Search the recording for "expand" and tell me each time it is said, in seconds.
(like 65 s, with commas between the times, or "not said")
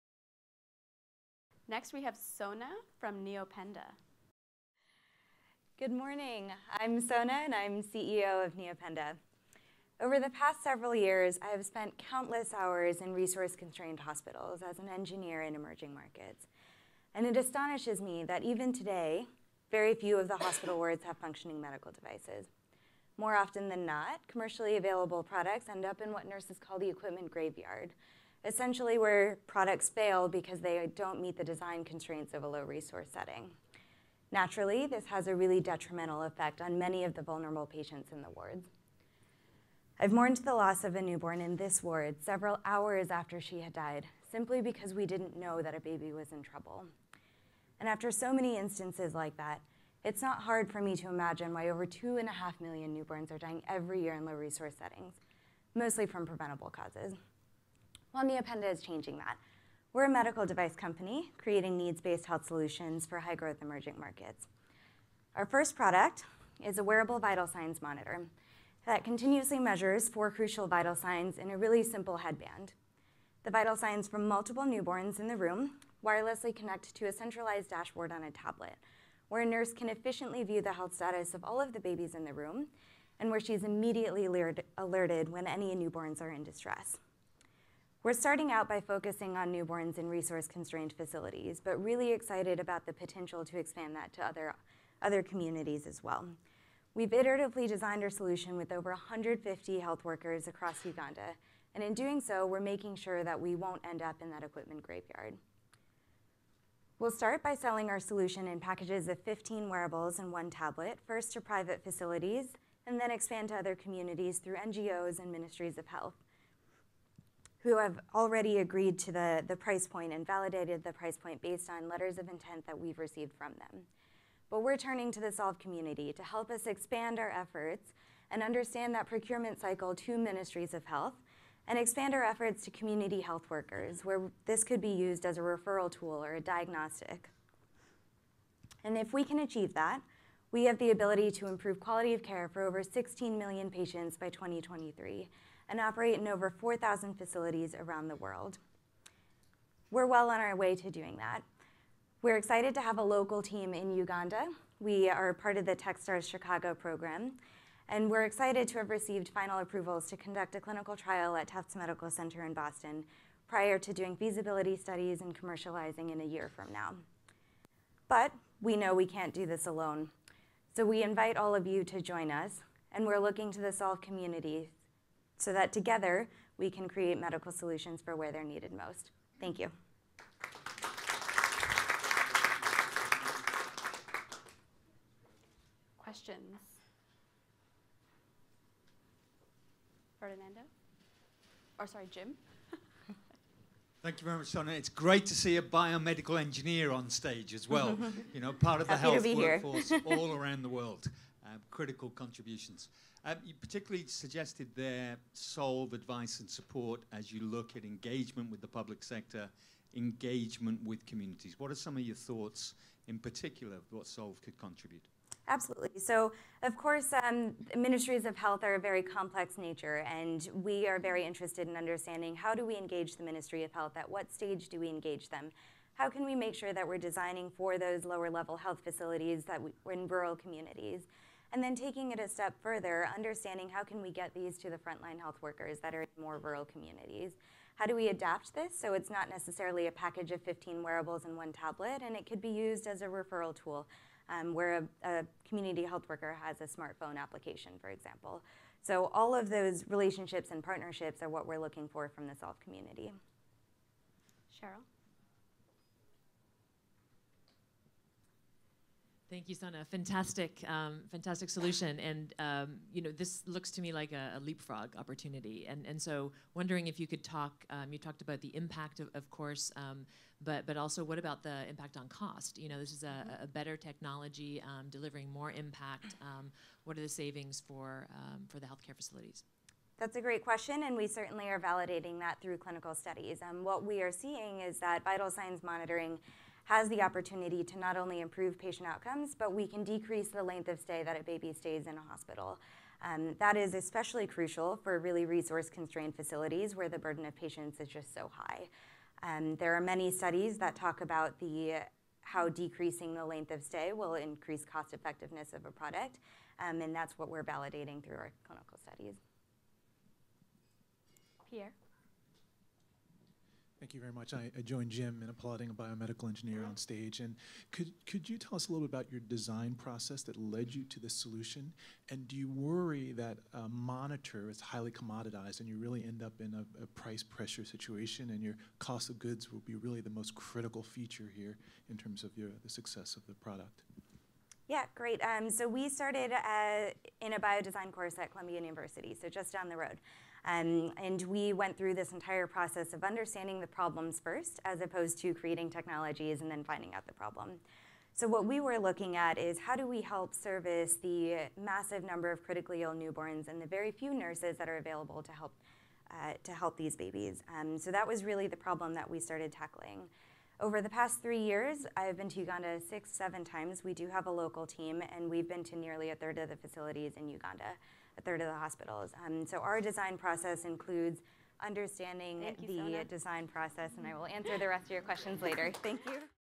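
93 s, 113 s, 126 s, 131 s.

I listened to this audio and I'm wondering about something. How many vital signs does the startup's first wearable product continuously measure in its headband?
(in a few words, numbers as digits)
4.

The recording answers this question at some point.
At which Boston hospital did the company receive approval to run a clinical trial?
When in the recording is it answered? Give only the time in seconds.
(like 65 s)
161 s.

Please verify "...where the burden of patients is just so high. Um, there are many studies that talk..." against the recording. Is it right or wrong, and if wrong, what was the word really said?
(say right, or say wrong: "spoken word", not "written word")
right.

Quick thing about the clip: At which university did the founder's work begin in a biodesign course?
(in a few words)
Columbia University.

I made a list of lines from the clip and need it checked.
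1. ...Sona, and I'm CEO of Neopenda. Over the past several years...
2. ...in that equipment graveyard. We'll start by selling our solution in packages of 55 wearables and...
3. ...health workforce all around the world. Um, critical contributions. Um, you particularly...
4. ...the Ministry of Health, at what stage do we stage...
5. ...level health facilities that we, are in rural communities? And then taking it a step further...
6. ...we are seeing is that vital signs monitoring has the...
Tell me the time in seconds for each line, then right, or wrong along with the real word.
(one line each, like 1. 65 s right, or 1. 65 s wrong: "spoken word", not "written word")
1. 6 s right
2. 104 s wrong: "15", not "55"
3. 198 s right
4. 223 s wrong: "engage", not "stage"
5. 228 s right
6. 283 s right.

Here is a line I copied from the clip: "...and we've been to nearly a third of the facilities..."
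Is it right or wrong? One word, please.
right.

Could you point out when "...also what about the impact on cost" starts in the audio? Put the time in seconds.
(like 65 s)
270 s.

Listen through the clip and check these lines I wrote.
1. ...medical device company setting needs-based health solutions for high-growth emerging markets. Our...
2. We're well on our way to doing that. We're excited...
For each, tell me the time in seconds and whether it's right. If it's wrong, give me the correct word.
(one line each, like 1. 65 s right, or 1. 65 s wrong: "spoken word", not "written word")
1. 60 s wrong: "creating", not "setting"
2. 149 s right.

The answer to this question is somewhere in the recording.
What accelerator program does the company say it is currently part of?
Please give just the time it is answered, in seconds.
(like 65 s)
155 s.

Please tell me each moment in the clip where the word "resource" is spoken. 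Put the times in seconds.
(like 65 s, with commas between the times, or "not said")
13 s, 32 s, 54 s, 90 s, 295 s.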